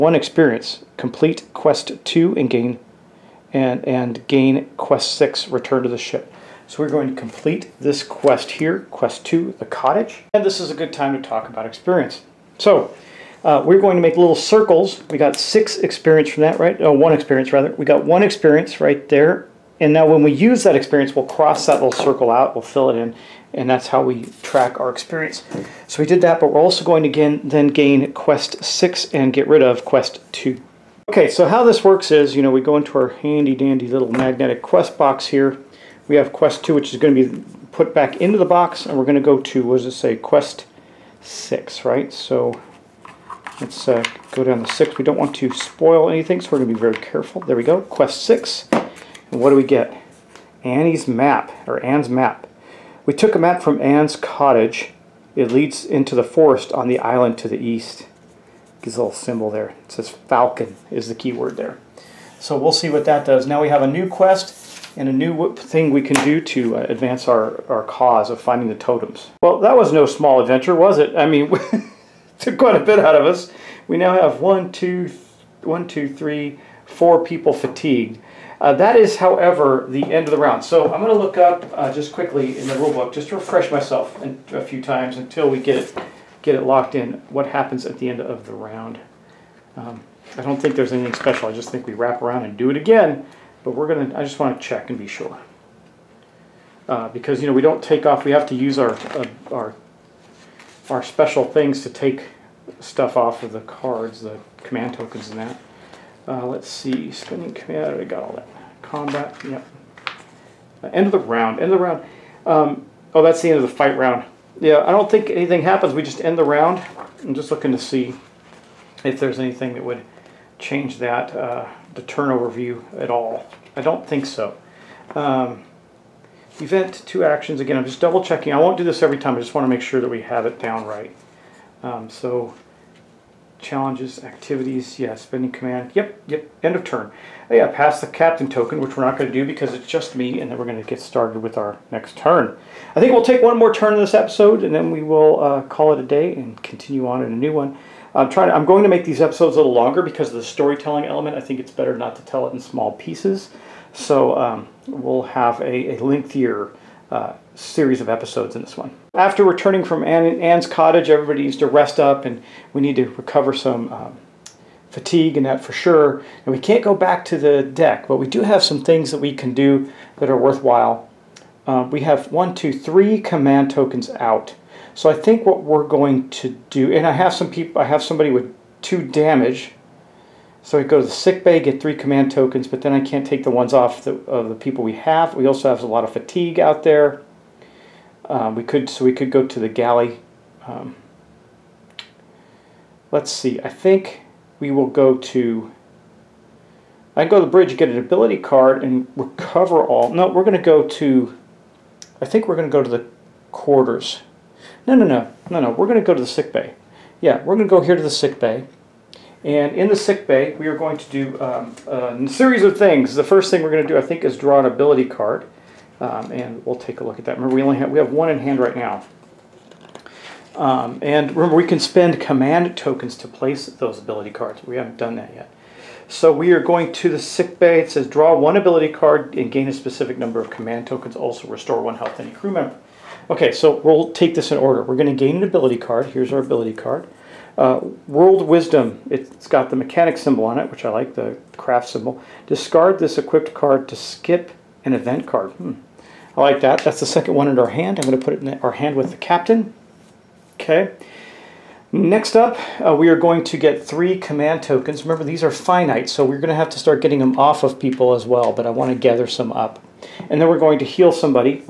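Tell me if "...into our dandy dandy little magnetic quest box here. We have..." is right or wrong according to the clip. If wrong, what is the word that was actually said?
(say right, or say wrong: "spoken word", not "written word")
wrong: "handy", not "dandy".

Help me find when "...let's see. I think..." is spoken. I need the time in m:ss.
3:13.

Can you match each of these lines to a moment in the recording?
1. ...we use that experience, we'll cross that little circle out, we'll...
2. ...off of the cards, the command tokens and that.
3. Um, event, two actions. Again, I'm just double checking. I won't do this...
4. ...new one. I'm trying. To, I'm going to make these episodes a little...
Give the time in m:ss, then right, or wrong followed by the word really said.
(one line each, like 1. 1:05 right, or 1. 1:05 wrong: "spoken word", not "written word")
1. 0:20 right
2. 1:43 right
3. 2:05 right
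4. 2:27 right.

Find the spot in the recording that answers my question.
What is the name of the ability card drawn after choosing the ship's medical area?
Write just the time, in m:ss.
3:58.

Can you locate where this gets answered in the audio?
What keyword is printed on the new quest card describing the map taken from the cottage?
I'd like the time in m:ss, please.
1:00.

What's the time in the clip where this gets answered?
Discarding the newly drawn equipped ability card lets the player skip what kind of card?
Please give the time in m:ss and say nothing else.
4:04.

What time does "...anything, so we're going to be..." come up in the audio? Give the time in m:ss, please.
0:46.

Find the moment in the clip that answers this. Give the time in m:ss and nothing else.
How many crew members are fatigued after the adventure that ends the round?
1:16.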